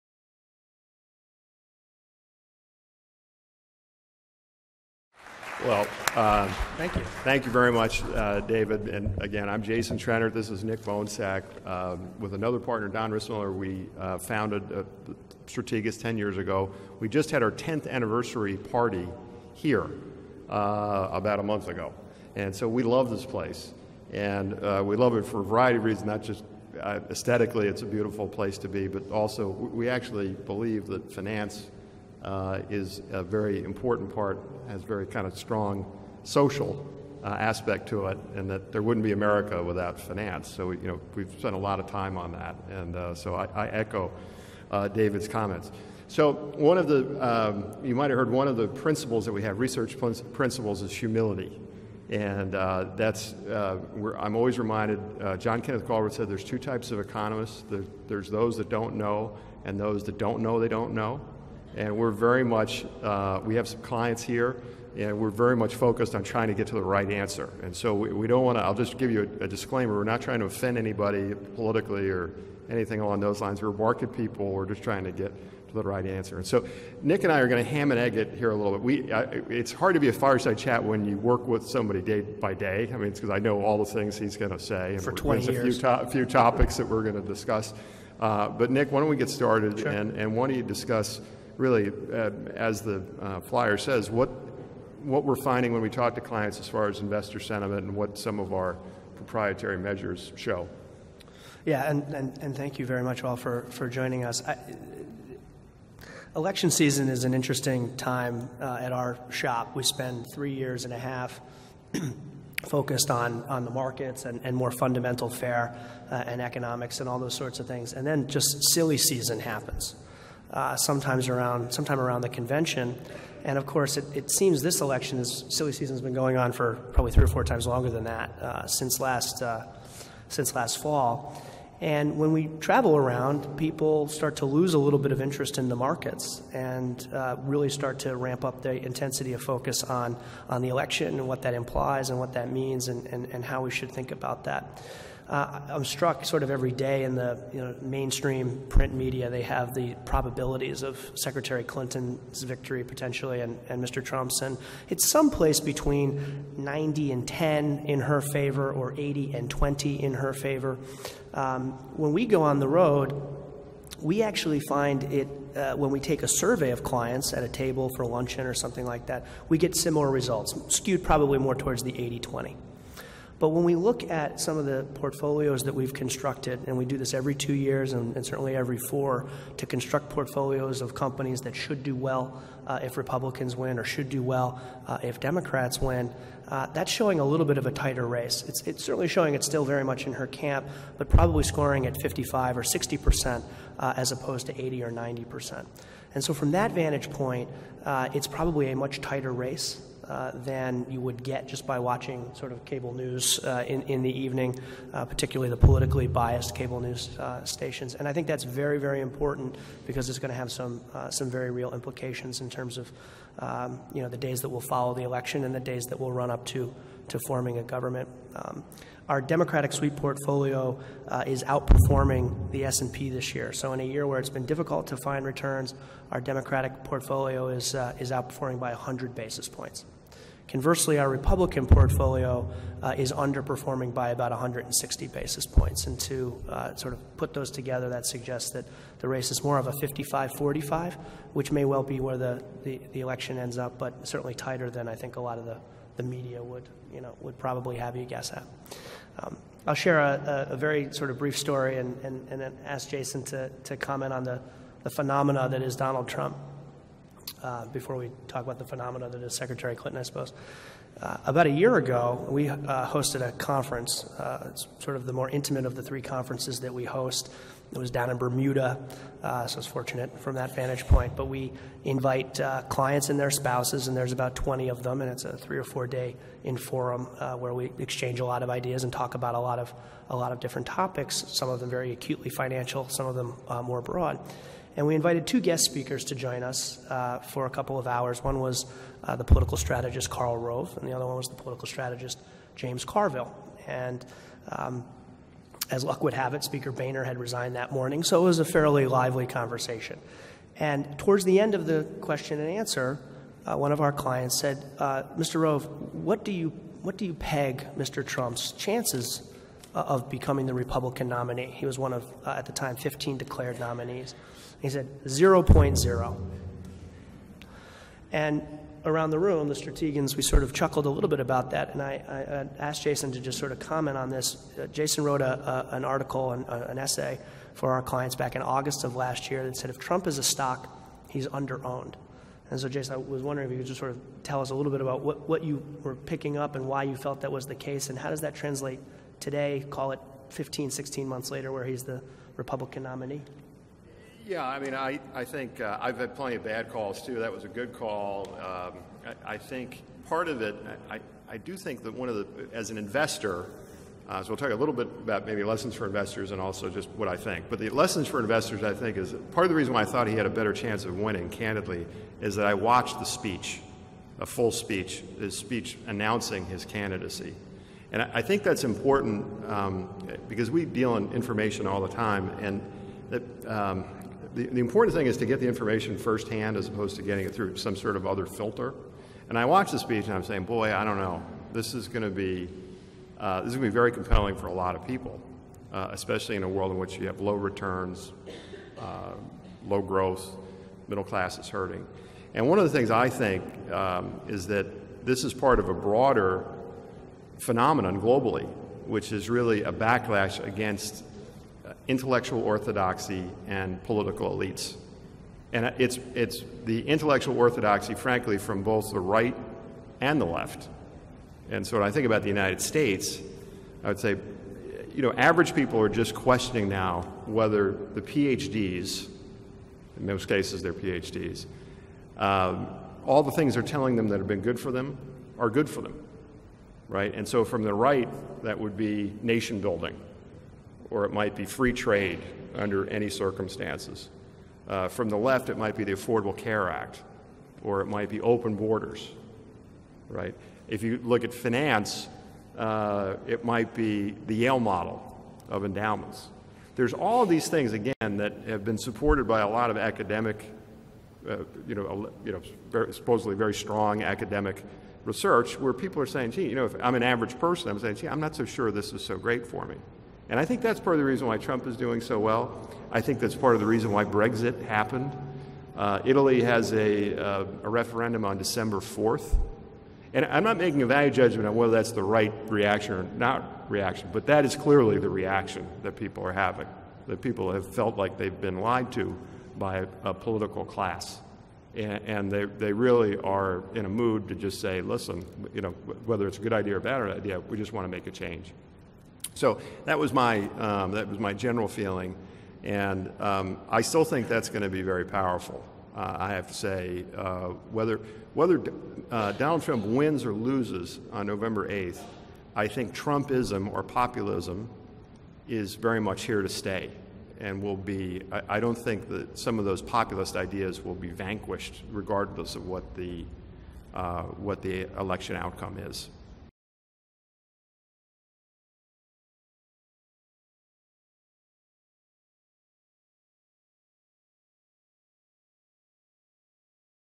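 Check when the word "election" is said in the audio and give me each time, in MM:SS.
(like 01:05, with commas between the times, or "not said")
01:46, 02:04, 02:20, 03:35, 04:02, 08:34.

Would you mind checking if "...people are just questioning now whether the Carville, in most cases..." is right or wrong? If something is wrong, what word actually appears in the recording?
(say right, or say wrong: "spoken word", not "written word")
wrong: "PhDs", not "Carville".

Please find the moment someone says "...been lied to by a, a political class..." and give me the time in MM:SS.
07:58.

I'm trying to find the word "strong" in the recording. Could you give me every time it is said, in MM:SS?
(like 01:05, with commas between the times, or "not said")
00:35, 07:33.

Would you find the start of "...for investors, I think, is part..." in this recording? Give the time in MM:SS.
05:58.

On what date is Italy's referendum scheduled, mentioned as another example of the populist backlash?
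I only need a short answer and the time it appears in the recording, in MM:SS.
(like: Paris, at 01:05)
December 4th, at 07:48.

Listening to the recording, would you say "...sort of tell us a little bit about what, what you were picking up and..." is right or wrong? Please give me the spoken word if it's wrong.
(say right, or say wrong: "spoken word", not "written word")
right.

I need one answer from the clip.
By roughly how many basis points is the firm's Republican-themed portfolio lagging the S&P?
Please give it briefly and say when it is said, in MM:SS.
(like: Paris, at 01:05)
160, at 03:54.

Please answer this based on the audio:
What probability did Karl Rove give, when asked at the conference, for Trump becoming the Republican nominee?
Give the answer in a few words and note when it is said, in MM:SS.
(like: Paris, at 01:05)
0.0, at 05:15.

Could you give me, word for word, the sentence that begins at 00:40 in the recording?
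So, you know, we've spent a lot of time on that, and uh, so I, I echo David's comments.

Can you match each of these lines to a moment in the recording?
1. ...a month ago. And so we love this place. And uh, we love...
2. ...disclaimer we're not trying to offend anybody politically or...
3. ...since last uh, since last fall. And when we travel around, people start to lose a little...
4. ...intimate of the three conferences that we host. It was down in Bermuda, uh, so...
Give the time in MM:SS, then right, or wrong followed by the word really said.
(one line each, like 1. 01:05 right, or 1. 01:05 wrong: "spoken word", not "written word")
1. 00:21 right
2. 01:09 right
3. 02:08 right
4. 04:25 right.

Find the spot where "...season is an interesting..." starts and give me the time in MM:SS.
01:46.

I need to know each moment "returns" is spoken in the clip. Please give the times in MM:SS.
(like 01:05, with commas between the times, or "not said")
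03:45, 06:27.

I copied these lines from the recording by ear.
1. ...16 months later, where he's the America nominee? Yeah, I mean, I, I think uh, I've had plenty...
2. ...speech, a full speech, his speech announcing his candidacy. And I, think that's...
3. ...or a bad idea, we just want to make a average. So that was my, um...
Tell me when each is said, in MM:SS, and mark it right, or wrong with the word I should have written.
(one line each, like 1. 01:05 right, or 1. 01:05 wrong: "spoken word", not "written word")
1. 05:40 wrong: "Republican", not "America"
2. 06:03 right
3. 08:06 wrong: "change", not "average".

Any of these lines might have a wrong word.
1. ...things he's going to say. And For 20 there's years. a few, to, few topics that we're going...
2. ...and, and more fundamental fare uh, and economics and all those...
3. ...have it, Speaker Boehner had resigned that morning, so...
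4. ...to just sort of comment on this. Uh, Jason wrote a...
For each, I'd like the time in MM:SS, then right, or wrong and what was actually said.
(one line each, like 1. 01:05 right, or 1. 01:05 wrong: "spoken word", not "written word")
1. 01:23 right
2. 01:54 right
3. 04:56 right
4. 05:23 right.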